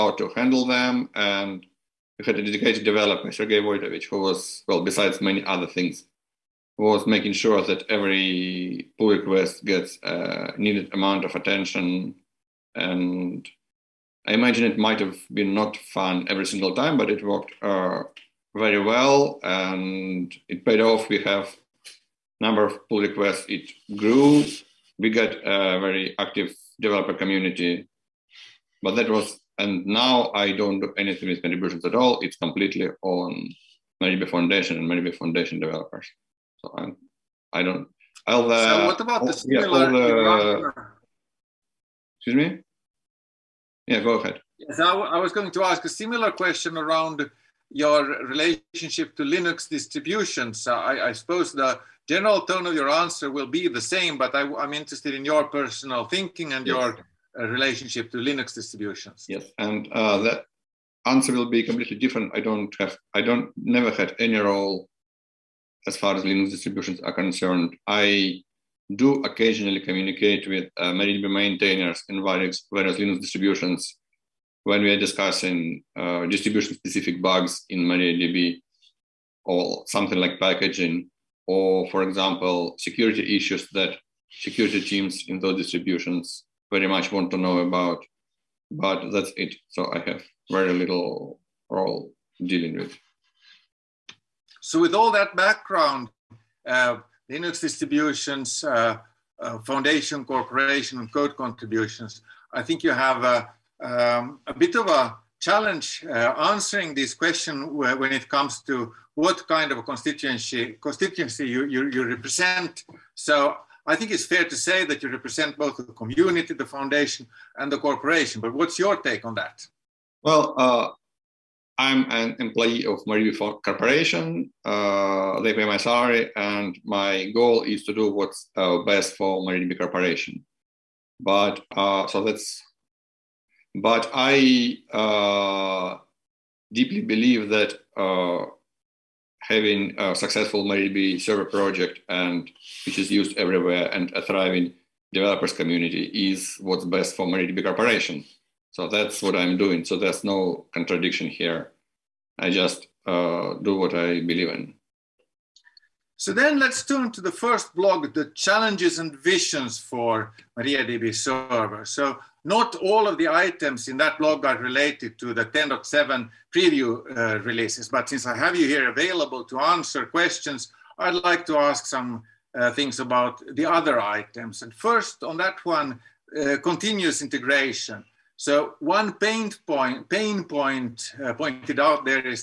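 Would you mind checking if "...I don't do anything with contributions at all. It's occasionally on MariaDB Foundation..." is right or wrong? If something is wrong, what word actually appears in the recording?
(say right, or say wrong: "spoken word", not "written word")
wrong: "completely", not "occasionally".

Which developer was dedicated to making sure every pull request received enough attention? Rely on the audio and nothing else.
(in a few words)
Sergey Vojtovich.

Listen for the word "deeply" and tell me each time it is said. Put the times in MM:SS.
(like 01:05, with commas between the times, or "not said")
02:16.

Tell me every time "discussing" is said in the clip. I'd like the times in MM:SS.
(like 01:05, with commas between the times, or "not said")
01:14.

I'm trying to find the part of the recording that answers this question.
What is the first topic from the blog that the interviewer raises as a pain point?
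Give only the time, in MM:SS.
02:56.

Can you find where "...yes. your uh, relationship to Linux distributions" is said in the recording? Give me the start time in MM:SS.
00:56.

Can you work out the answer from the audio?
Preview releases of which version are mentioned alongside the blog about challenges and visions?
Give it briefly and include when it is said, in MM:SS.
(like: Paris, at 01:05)
10.7, at 02:45.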